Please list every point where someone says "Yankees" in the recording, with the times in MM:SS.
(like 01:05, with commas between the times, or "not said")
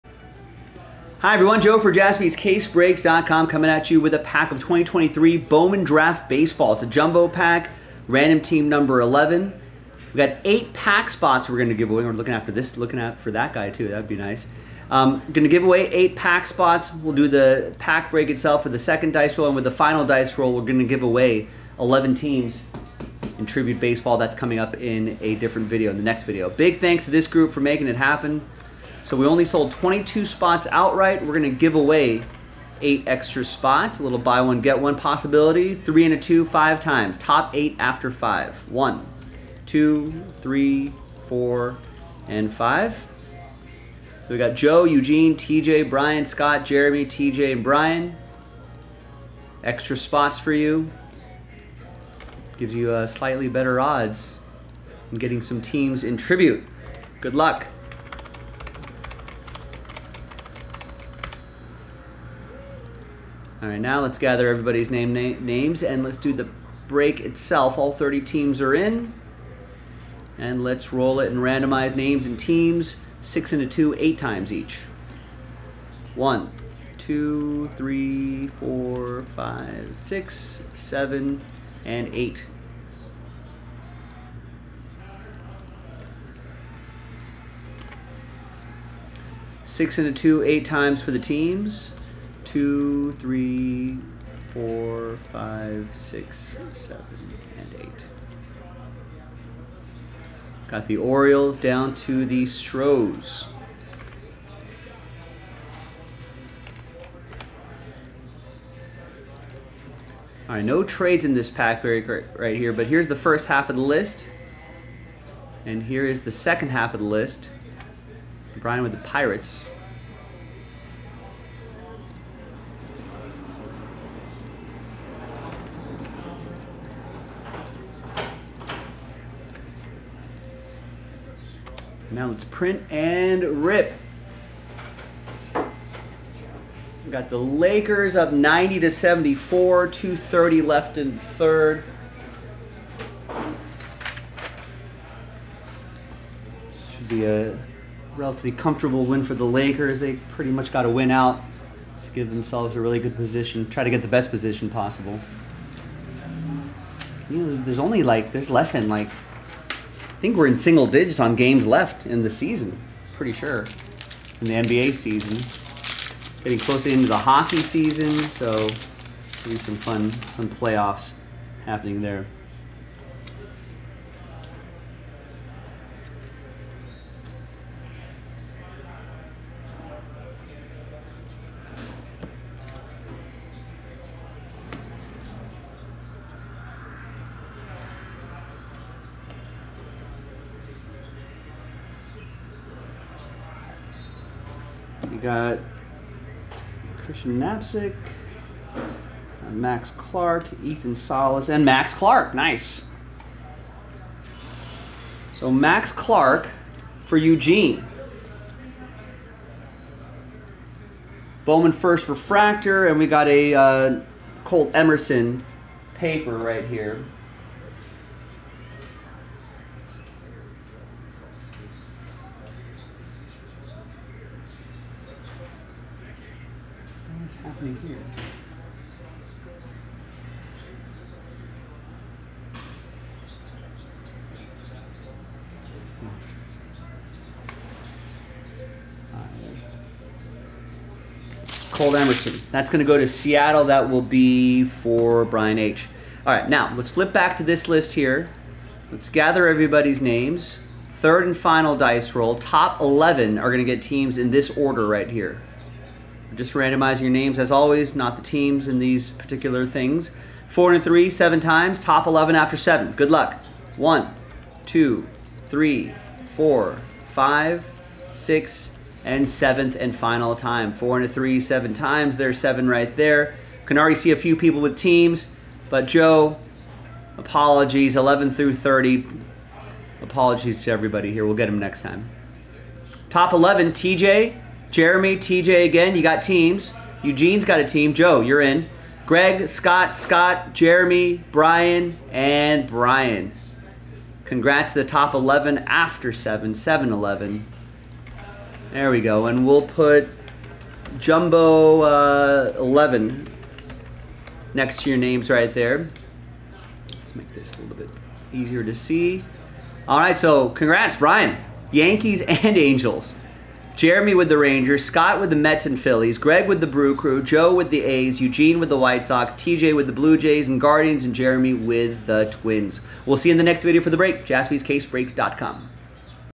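05:11.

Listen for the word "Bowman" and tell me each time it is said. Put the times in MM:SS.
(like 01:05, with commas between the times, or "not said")
00:05, 03:31.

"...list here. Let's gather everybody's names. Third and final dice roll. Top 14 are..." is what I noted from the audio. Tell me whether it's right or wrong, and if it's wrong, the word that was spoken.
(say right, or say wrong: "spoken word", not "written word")
wrong: "11", not "14".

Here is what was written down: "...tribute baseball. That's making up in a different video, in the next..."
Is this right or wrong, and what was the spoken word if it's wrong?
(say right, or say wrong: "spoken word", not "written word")
wrong: "coming", not "making".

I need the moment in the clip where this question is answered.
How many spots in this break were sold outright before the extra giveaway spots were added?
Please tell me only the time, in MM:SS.
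00:29.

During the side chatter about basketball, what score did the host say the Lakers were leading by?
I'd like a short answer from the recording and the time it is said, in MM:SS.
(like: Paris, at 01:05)
90 to 74, at 02:18.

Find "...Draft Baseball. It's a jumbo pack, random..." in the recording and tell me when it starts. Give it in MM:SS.
00:05.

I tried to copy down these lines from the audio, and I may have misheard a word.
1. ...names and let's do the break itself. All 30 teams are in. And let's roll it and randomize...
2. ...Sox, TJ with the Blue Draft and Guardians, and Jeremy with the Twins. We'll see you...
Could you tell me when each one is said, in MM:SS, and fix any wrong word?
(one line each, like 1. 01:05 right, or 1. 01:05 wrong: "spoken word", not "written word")
1. 01:05 right
2. 05:19 wrong: "Jays", not "Draft".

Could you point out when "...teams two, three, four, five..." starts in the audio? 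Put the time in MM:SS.
01:31.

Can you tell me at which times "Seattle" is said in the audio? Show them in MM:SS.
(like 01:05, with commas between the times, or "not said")
04:03.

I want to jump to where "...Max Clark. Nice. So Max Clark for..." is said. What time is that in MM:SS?
03:21.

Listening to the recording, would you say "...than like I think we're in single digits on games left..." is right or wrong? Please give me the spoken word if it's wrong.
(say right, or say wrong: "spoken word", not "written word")
right.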